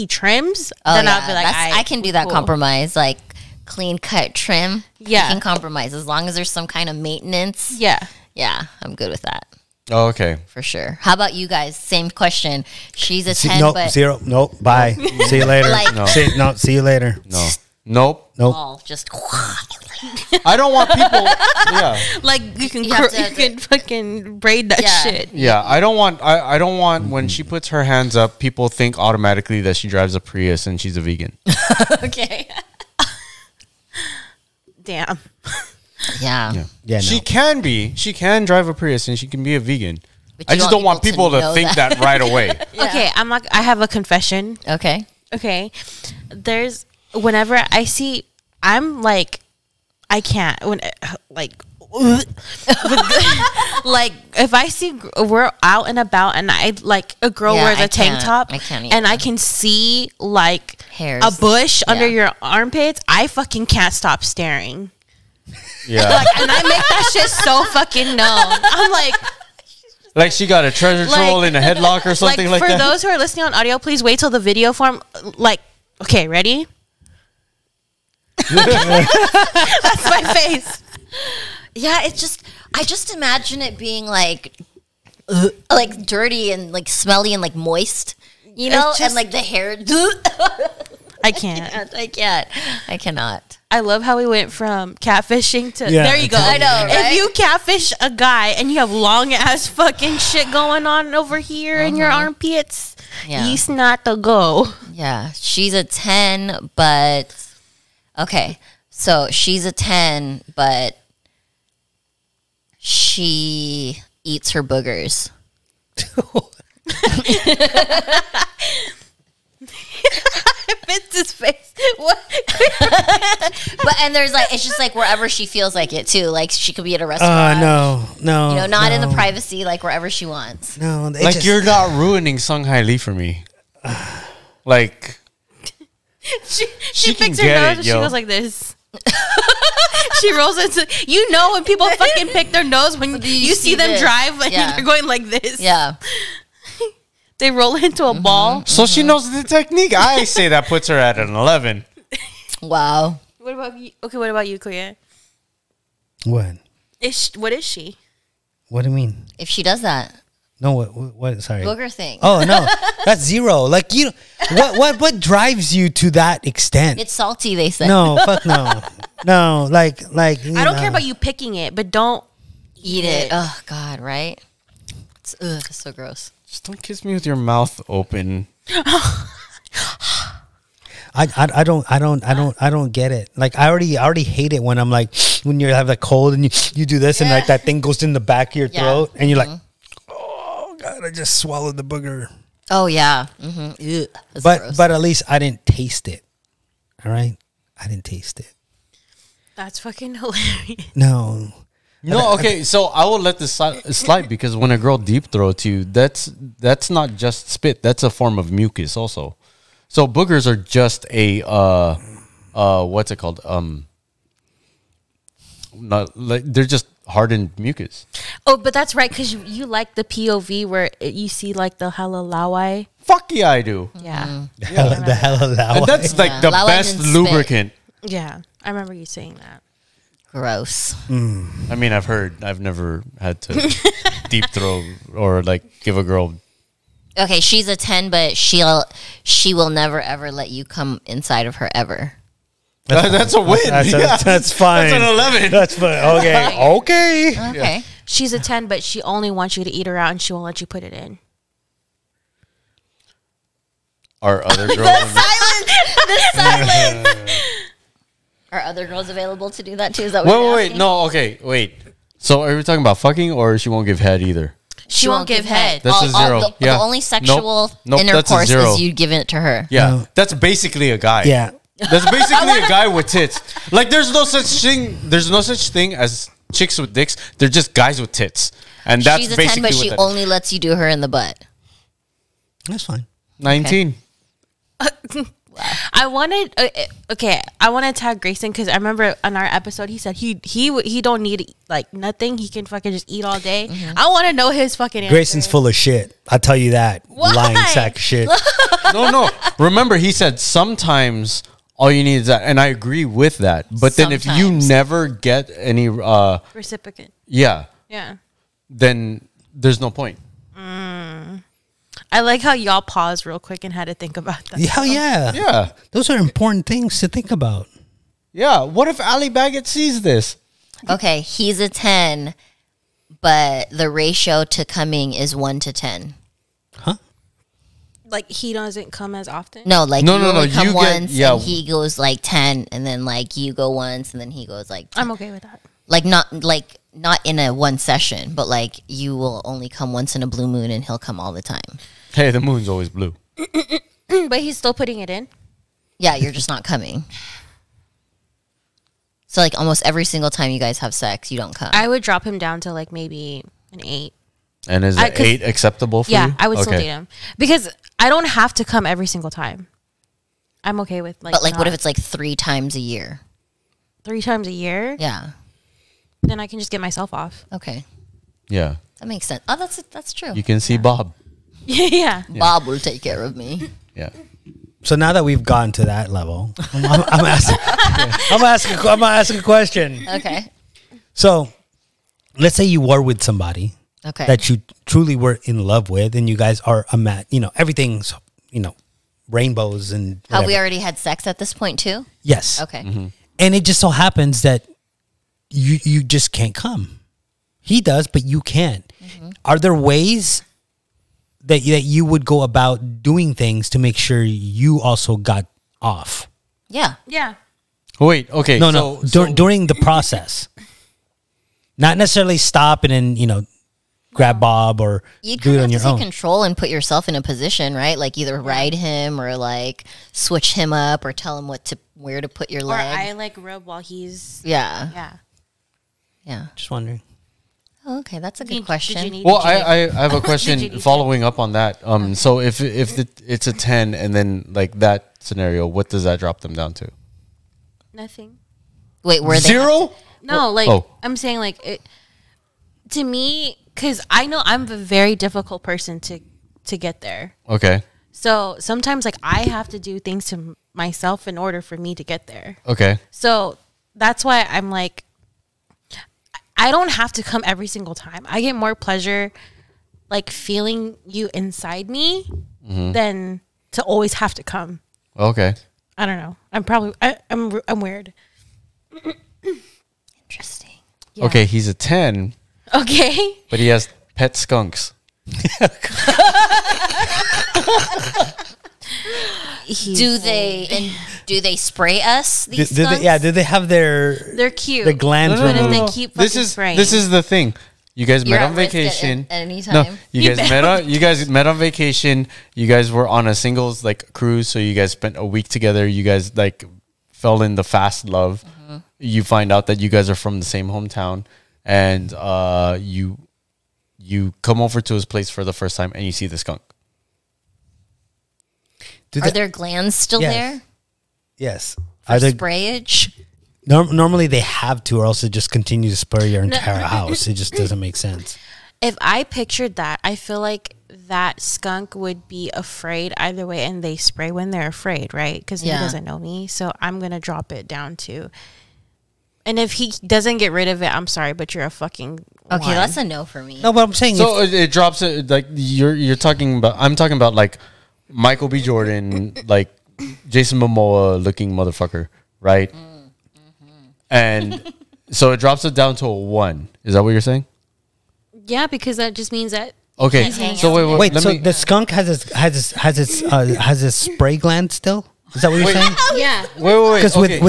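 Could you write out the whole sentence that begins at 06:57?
Like either ride him or like switch him up or tell him what to where to put your or leg.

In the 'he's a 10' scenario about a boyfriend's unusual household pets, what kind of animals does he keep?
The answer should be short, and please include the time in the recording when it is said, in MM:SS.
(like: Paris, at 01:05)
Skunks, at 07:54.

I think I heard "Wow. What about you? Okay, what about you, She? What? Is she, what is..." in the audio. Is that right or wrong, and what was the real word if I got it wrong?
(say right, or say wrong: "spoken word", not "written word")
wrong: "Kuya", not "She".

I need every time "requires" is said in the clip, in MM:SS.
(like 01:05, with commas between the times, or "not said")
not said.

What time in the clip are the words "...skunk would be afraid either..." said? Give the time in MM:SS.
08:41.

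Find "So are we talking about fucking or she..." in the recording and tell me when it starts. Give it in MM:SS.
04:22.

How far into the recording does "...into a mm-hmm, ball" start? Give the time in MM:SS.
02:27.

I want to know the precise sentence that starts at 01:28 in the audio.
You know, just, and like the hair.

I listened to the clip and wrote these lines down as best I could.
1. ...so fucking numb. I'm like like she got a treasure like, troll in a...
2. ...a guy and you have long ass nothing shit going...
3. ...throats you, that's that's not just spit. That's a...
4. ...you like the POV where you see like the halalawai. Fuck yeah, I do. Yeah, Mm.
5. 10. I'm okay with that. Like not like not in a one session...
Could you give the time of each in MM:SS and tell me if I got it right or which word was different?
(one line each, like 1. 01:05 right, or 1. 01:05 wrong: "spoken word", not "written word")
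1. 01:07 right
2. 01:37 wrong: "fucking", not "nothing"
3. 03:25 right
4. 03:39 right
5. 05:34 right.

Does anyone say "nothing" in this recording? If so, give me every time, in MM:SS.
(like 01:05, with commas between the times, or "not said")
04:51, 07:17.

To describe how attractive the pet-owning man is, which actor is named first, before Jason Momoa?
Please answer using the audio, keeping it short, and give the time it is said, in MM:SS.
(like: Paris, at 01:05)
Michael B. Jordan, at 08:58.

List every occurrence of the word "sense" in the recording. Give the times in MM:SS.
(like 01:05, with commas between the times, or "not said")
06:09, 08:37.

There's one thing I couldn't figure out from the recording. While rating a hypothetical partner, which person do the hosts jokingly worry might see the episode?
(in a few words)
Ali Baggett.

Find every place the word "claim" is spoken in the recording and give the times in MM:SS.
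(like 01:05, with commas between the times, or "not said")
not said.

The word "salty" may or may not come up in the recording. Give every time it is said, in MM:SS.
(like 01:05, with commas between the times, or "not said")
02:47.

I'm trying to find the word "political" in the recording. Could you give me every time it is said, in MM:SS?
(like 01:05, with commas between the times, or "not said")
not said.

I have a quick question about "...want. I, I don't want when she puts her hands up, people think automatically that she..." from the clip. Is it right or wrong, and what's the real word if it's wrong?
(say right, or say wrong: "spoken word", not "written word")
right.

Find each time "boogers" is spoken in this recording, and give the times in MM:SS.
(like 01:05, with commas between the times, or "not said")
01:54, 02:41, 03:11, 03:30.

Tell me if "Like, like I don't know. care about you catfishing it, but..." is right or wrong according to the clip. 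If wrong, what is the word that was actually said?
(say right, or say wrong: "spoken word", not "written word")
wrong: "picking", not "catfishing".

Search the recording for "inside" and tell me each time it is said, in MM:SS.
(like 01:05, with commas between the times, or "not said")
04:01, 07:41.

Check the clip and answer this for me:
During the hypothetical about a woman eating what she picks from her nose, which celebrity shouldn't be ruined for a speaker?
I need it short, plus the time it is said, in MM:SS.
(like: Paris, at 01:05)
Sung Hi Lee, at 02:12.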